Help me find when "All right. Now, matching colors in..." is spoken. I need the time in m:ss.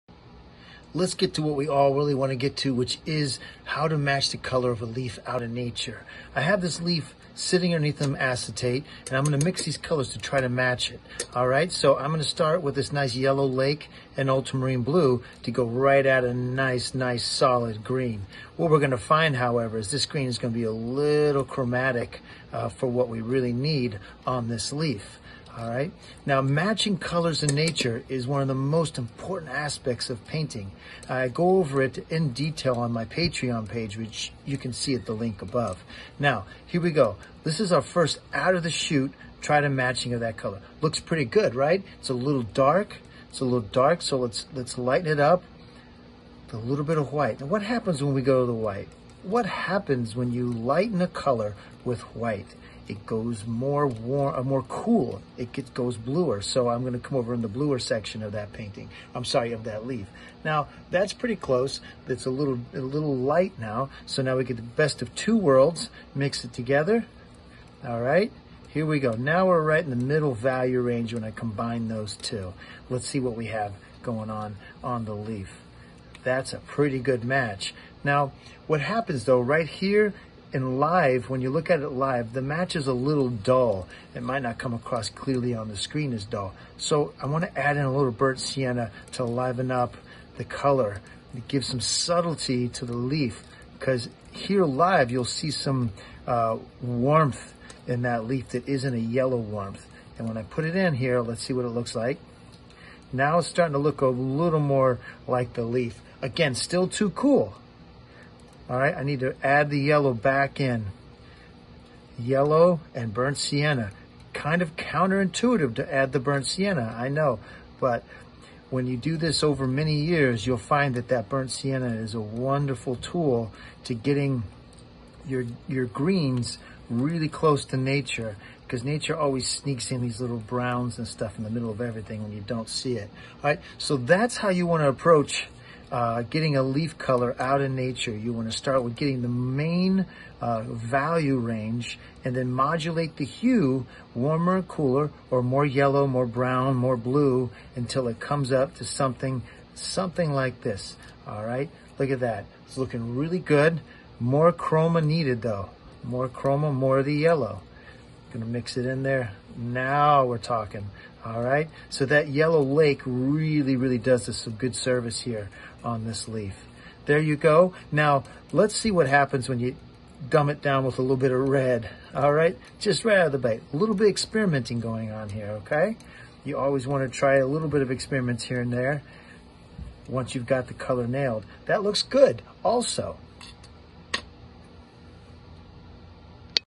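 0:25.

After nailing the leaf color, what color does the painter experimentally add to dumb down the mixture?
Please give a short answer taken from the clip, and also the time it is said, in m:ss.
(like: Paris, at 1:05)
red, at 2:51.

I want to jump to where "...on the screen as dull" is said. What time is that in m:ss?
1:25.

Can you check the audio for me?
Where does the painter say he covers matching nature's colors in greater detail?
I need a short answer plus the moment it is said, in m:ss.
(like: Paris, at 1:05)
Patreon, at 0:33.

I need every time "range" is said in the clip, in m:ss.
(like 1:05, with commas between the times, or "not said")
1:10, 2:21.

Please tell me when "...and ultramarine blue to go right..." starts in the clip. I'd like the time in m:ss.
0:14.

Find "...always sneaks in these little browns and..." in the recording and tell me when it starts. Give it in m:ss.
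2:09.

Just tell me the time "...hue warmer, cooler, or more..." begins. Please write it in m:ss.
2:23.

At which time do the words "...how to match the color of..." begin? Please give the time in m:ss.
0:03.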